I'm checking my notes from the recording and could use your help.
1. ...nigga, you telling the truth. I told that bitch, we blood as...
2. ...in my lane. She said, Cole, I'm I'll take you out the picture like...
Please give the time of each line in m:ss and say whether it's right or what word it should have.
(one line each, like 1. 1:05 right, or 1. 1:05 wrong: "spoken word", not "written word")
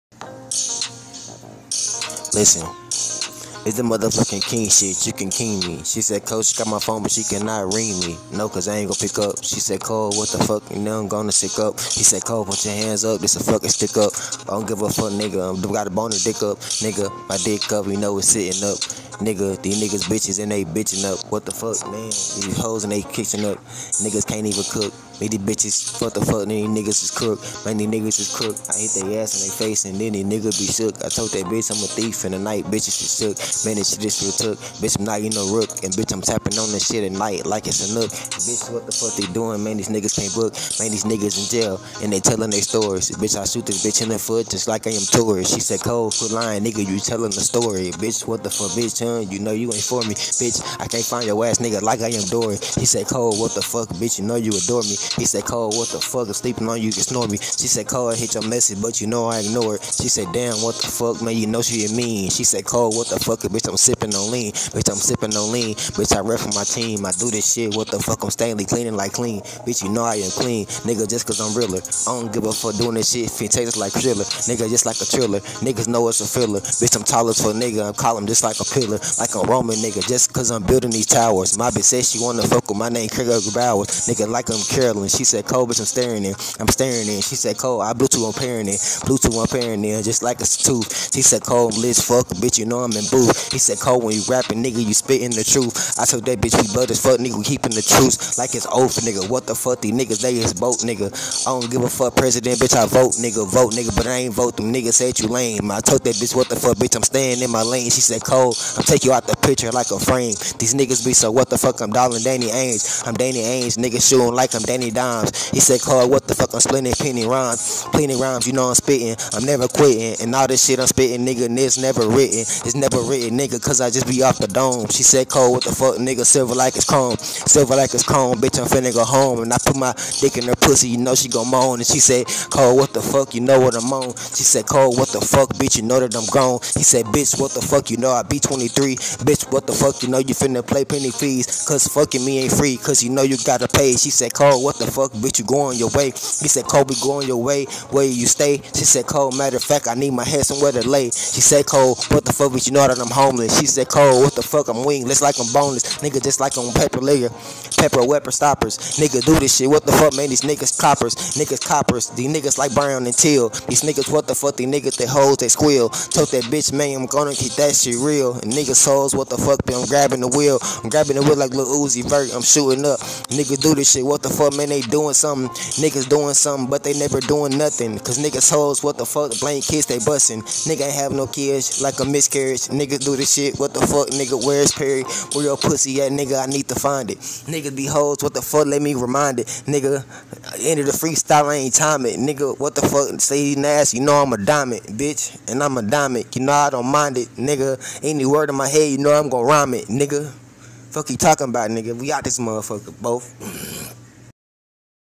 1. 1:34 wrong: "spitting", not "telling"
2. 1:47 right.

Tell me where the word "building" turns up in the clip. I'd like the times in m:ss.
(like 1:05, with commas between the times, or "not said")
1:20.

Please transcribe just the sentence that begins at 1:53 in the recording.
I'm Danny Ainge, niggas shooting like I'm Danny Dimes.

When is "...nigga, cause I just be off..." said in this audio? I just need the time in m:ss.
2:03.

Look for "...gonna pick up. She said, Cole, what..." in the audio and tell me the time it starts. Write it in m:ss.
0:08.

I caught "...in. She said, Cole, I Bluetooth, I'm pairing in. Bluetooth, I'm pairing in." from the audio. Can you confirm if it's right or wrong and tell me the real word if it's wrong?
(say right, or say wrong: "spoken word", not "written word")
right.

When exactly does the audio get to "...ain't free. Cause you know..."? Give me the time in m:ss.
2:22.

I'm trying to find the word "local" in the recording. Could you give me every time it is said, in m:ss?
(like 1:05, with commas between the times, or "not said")
not said.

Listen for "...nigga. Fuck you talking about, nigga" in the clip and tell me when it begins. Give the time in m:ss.
3:19.